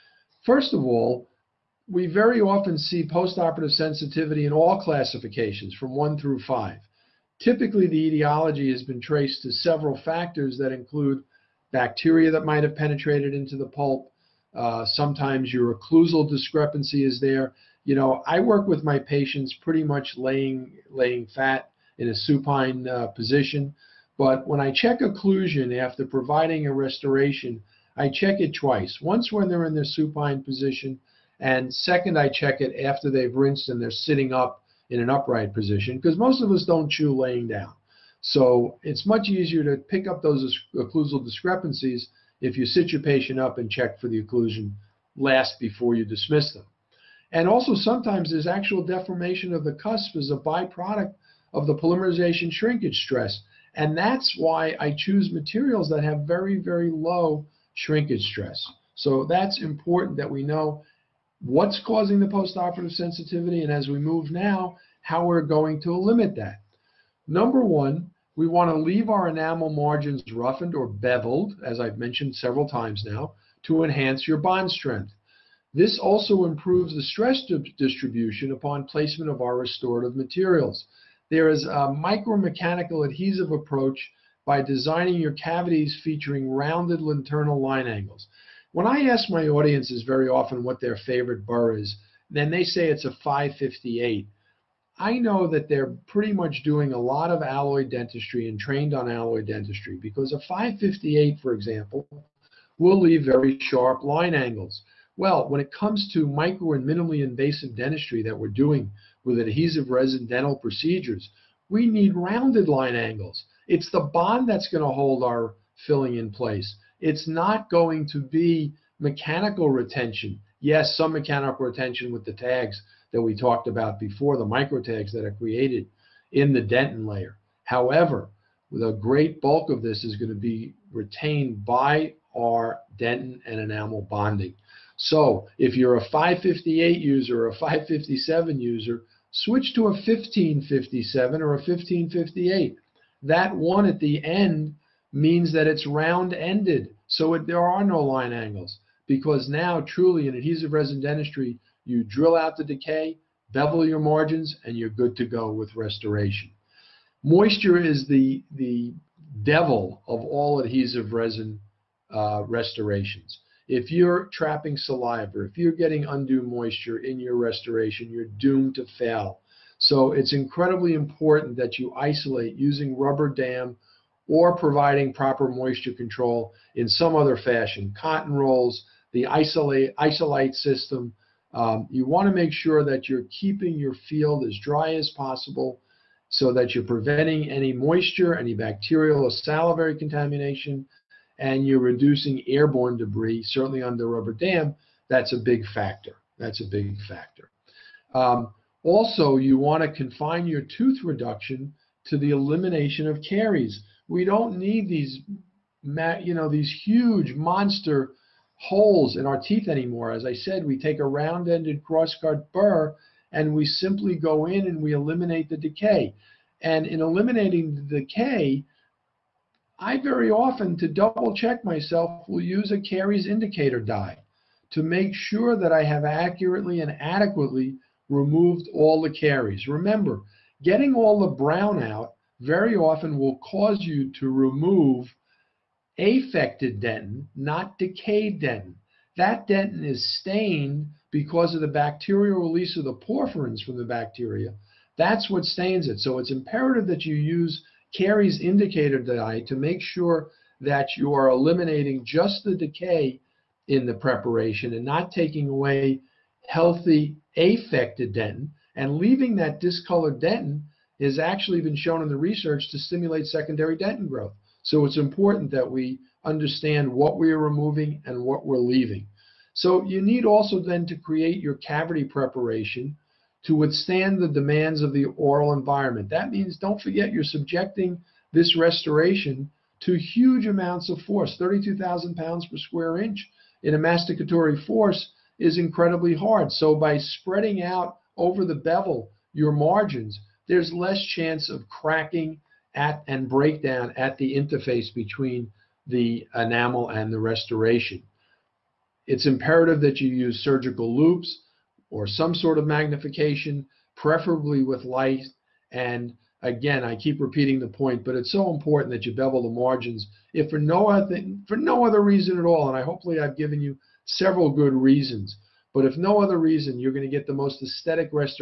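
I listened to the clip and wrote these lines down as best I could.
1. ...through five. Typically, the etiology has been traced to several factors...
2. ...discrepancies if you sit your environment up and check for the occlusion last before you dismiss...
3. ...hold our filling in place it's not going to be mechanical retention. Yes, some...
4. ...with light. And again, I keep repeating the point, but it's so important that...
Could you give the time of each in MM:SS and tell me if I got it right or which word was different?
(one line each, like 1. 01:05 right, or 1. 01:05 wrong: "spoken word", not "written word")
1. 00:06 right
2. 00:41 wrong: "patient", not "environment"
3. 01:54 right
4. 05:04 right.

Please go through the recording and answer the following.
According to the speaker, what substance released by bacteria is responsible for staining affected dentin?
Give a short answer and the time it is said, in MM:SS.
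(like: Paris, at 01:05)
porphyrins, at 04:02.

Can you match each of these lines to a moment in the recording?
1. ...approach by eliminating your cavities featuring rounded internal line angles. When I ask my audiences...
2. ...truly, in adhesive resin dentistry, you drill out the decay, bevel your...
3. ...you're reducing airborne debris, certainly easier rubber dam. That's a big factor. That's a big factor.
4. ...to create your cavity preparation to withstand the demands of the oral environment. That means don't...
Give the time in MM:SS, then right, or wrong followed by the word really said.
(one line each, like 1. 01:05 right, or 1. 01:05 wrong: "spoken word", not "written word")
1. 01:23 wrong: "designing", not "eliminating"
2. 02:29 right
3. 03:11 wrong: "under", not "easier"
4. 04:30 right.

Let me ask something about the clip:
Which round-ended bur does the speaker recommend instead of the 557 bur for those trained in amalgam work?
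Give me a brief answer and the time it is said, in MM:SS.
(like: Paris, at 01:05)
1557, at 02:19.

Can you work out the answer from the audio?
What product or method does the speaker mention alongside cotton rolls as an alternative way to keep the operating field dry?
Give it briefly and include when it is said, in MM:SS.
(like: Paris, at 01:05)
Isolite system, at 02:59.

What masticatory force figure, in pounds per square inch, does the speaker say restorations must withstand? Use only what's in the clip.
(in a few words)
32,000.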